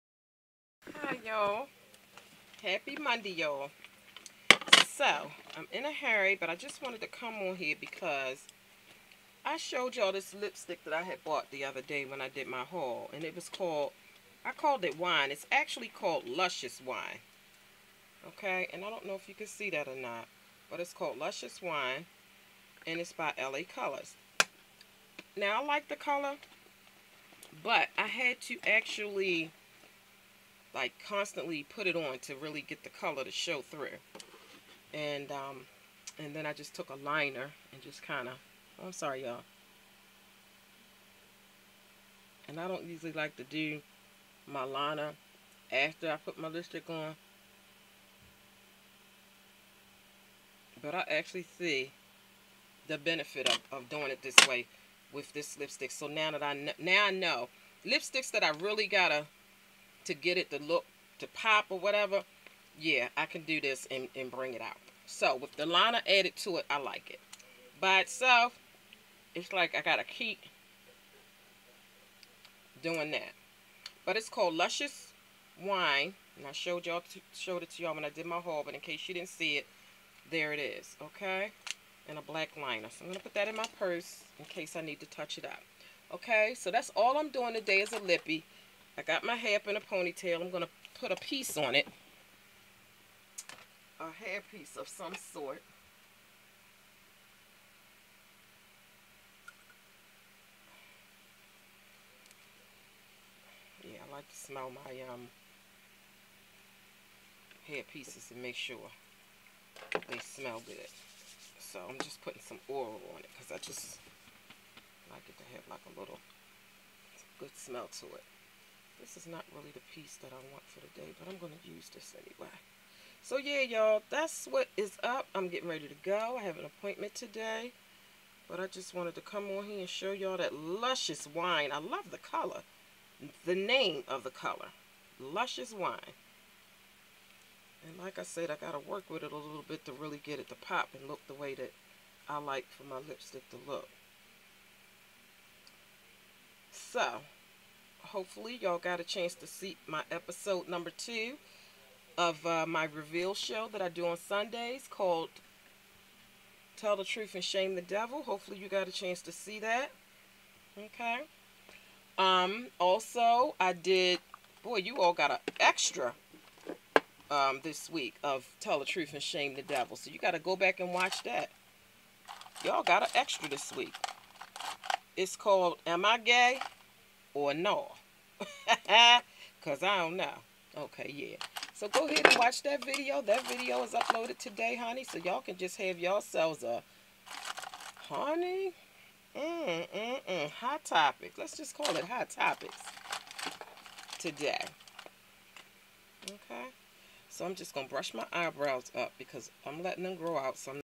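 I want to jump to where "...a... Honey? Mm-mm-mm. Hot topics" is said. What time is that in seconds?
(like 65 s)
186 s.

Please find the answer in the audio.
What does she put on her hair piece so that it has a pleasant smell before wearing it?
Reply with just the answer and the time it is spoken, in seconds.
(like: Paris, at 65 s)
Oil, at 112 s.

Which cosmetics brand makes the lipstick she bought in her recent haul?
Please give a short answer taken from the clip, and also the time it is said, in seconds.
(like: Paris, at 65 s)
LA Colors, at 23 s.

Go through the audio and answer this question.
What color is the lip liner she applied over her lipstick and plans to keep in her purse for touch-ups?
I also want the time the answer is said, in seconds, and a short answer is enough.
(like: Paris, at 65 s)
Black, at 82 s.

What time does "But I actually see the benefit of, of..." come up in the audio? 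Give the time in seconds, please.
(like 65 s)
50 s.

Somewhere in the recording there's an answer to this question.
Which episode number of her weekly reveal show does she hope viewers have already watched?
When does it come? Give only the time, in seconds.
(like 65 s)
150 s.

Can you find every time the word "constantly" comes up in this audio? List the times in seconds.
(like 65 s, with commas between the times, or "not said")
31 s.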